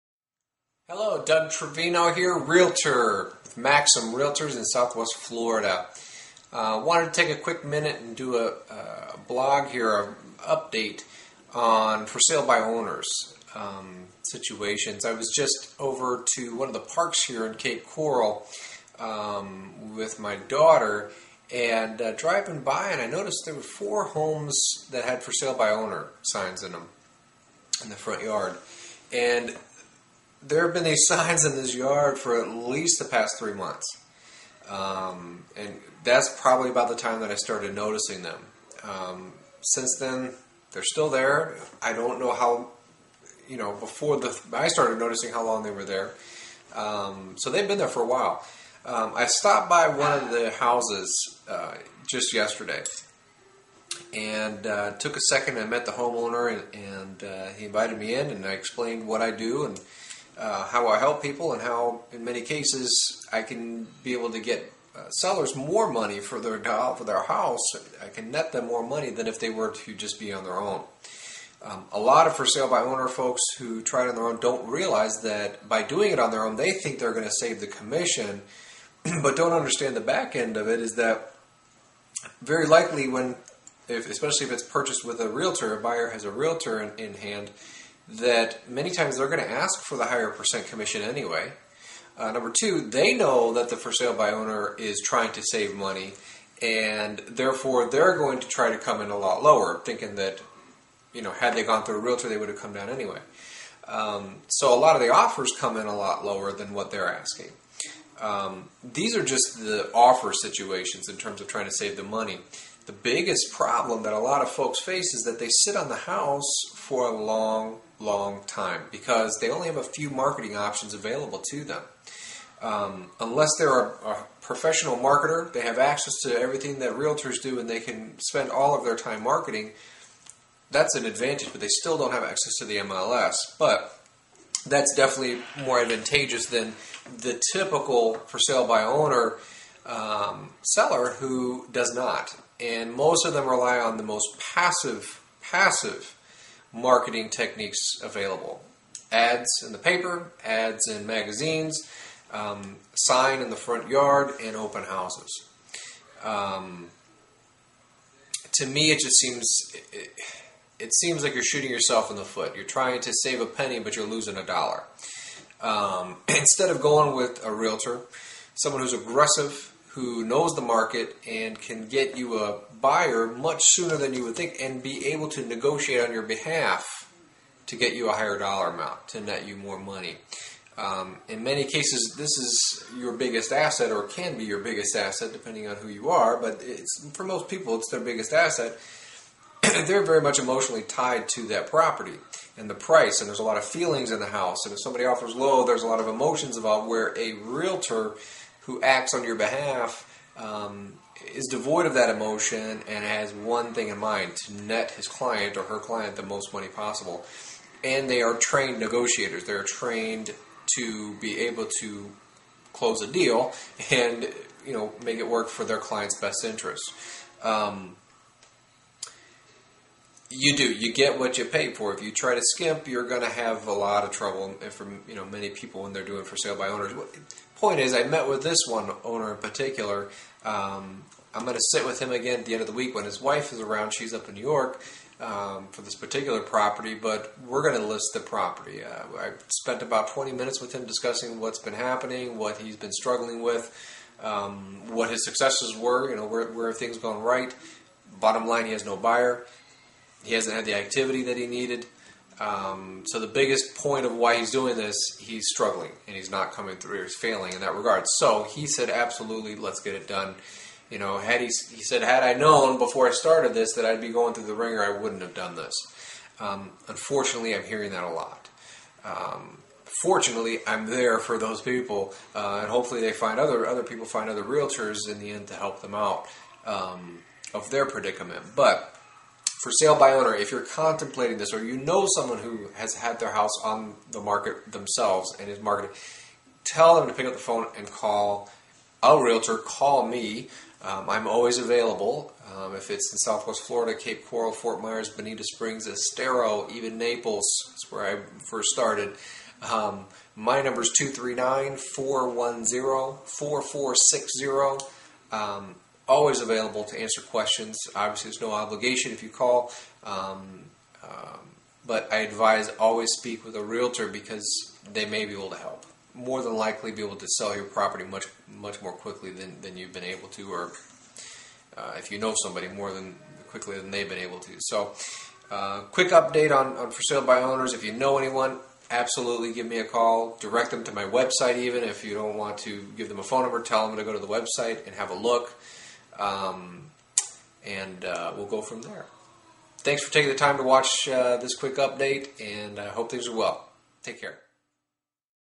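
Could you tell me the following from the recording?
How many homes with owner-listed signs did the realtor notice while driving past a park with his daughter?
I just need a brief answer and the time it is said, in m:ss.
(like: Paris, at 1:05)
4, at 0:23.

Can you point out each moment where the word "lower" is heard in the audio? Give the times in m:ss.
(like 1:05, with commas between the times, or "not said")
1:39, 1:46.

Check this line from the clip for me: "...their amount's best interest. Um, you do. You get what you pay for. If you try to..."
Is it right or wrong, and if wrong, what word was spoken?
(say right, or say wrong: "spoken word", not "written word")
wrong: "client", not "amount".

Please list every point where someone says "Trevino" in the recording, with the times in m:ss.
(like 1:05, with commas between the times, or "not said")
0:01.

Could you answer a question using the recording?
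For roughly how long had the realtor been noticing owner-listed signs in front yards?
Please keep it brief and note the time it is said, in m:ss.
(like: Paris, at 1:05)
3 months, at 0:33.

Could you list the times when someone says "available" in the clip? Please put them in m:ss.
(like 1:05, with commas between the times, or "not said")
2:00, 2:28, 4:51, 5:06.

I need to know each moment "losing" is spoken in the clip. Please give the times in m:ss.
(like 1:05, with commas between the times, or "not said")
2:44.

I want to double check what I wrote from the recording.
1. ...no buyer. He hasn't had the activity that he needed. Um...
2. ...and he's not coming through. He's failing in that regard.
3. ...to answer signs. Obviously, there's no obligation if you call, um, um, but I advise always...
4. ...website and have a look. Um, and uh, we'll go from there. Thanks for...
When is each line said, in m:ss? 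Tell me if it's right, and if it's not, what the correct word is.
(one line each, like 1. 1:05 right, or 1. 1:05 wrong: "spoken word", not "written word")
1. 4:08 right
2. 4:16 right
3. 5:06 wrong: "questions", not "signs"
4. 5:34 right.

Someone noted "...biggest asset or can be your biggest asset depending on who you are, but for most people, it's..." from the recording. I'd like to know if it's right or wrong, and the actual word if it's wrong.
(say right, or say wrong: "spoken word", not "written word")
right.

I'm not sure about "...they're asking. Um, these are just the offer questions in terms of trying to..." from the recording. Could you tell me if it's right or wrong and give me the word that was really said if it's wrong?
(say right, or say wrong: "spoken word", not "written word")
wrong: "situations", not "questions".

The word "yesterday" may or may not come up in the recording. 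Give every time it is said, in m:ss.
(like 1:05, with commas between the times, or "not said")
0:52.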